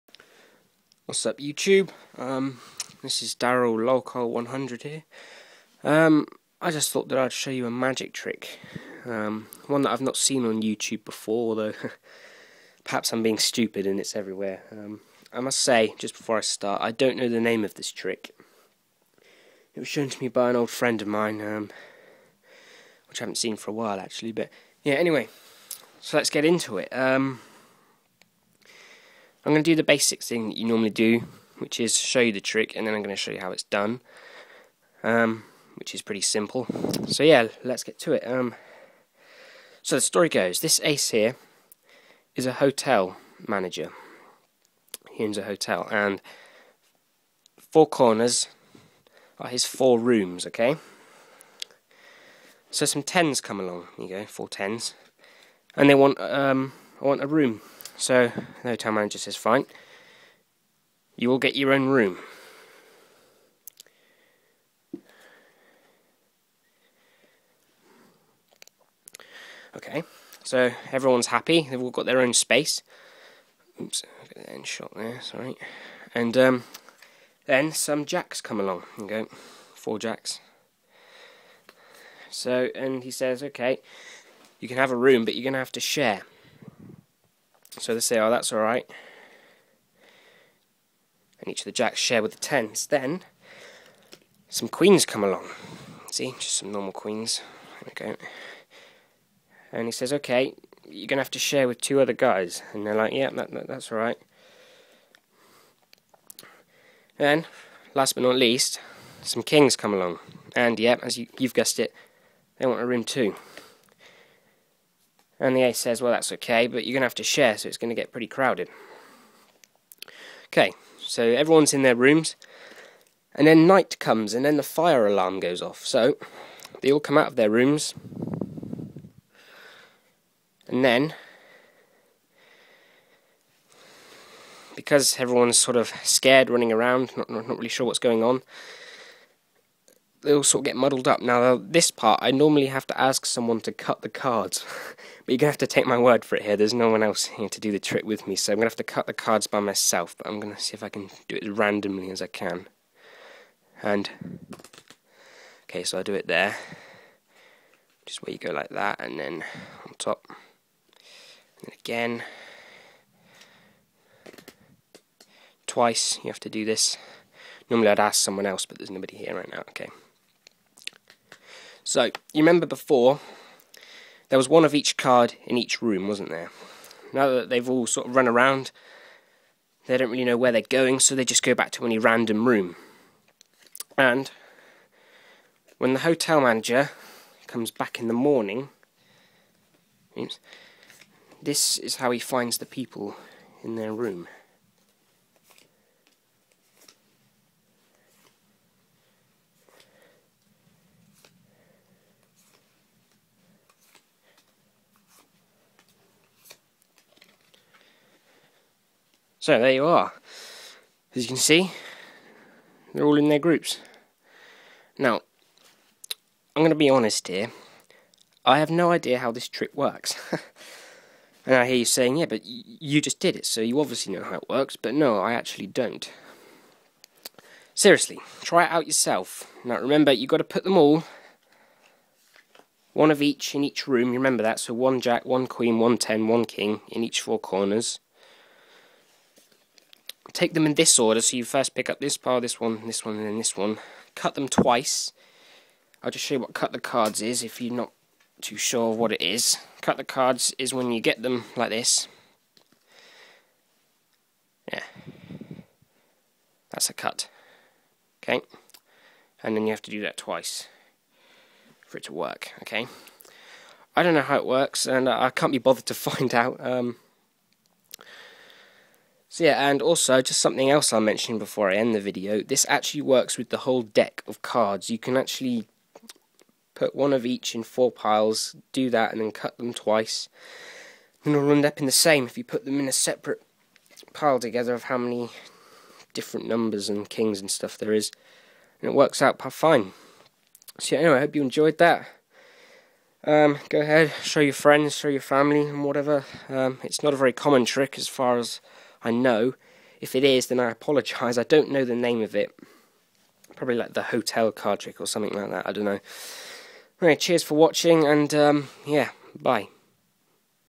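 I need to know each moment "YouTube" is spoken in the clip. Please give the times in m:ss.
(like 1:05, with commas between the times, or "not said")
0:01, 0:10.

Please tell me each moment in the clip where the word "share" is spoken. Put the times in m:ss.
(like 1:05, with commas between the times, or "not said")
1:25, 1:31, 1:41, 1:57.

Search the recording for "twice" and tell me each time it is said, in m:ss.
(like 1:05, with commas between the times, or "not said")
2:45, 4:04, 4:20, 4:39.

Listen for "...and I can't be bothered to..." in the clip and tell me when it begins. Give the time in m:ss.
4:24.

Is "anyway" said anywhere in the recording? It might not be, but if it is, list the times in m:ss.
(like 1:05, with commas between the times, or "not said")
0:24, 4:51, 5:07.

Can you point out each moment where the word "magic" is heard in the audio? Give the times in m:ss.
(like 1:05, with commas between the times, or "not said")
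0:07.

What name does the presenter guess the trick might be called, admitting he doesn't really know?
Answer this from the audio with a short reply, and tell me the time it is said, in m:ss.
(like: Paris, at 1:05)
The hotel card trick, at 5:03.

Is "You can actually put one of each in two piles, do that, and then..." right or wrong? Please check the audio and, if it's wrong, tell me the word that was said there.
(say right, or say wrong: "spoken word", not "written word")
wrong: "four", not "two".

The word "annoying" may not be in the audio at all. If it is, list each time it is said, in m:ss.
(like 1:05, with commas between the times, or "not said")
not said.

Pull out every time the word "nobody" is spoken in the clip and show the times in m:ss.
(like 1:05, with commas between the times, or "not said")
2:48.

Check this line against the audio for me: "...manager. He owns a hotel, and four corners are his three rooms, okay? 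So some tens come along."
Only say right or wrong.
wrong.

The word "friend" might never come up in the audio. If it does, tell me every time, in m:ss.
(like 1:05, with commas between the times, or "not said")
0:20, 4:54.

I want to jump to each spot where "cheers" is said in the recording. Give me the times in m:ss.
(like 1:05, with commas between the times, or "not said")
5:07.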